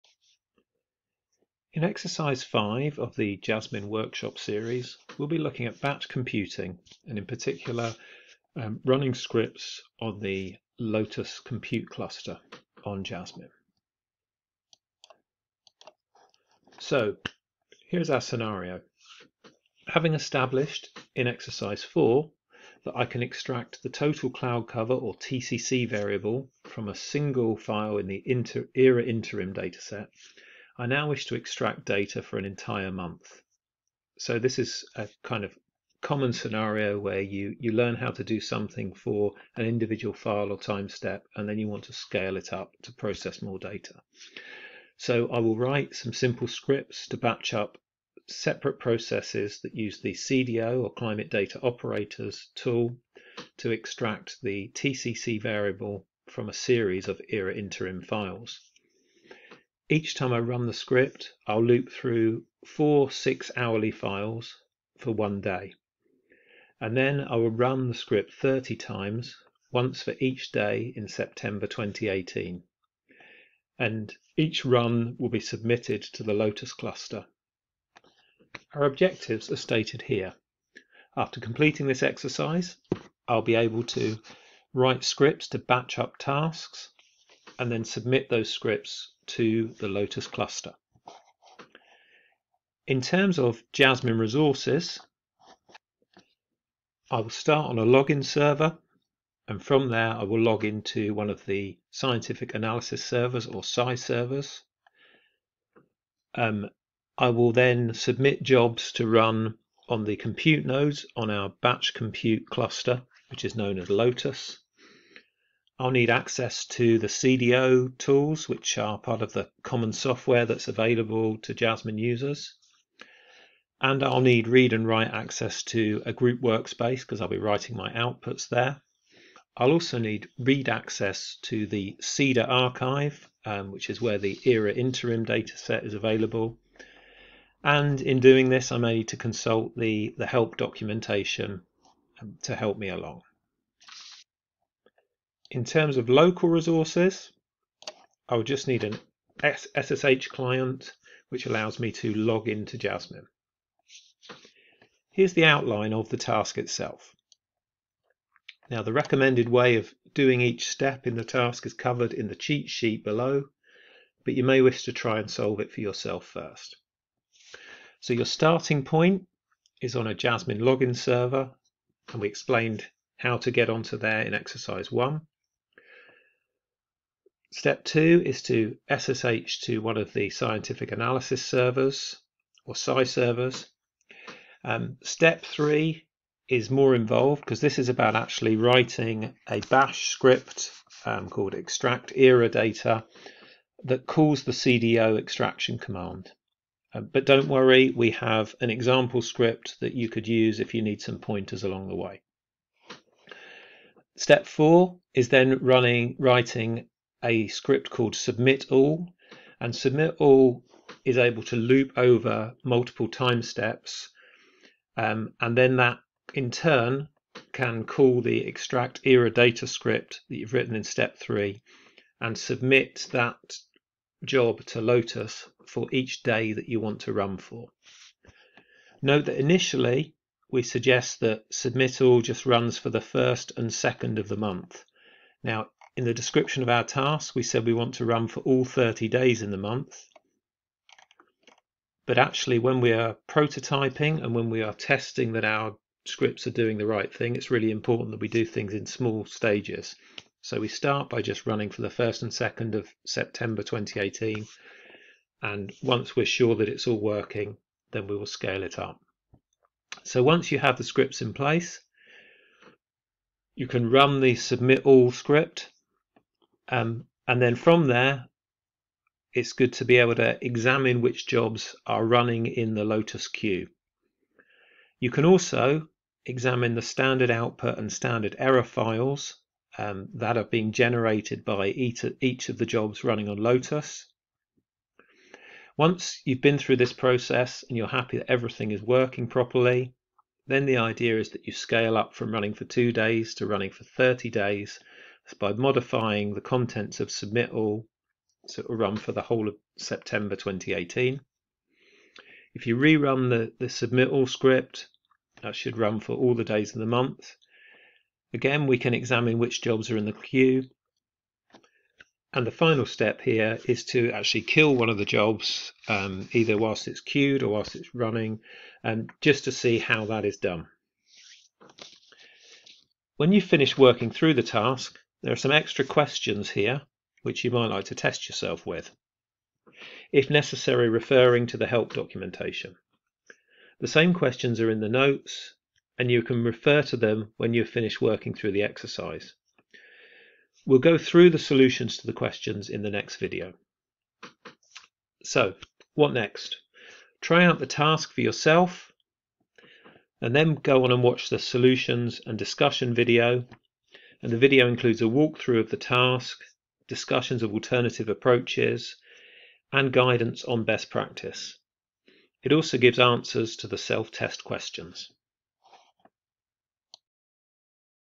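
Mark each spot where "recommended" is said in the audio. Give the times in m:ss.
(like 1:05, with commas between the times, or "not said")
2:38.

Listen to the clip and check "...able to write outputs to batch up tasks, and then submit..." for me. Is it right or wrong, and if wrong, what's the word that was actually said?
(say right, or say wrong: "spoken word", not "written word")
wrong: "scripts", not "outputs".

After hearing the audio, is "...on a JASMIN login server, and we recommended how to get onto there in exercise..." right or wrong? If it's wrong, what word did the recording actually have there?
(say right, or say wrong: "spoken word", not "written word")
wrong: "explained", not "recommended".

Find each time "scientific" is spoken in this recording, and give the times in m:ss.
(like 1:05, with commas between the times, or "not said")
1:41, 3:00.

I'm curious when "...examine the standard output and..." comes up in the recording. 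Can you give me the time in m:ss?
4:36.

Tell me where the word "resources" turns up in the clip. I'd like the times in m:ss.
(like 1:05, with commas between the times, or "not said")
1:34, 2:26.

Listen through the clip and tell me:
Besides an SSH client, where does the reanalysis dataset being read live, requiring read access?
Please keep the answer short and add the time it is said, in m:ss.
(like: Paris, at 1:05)
CEDA archive, at 2:11.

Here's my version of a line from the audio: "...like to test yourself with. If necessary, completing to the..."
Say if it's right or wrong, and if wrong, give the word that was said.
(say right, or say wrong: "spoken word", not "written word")
wrong: "referring", not "completing".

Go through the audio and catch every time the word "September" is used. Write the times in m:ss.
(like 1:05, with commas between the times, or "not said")
1:11, 4:13, 4:59.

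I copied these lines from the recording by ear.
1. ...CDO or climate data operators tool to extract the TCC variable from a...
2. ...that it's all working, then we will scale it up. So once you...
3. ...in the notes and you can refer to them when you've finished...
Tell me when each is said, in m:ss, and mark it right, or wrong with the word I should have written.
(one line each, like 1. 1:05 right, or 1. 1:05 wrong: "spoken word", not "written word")
1. 0:50 right
2. 4:16 right
3. 5:34 right.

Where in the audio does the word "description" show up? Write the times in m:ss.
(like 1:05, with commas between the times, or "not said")
3:56.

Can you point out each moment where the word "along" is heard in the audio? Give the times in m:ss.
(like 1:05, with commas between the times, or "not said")
2:22, 3:21.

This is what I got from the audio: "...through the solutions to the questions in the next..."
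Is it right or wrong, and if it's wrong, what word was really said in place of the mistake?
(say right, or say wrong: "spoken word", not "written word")
right.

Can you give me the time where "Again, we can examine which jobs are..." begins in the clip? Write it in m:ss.
5:08.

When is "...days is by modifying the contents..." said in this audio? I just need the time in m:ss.
4:54.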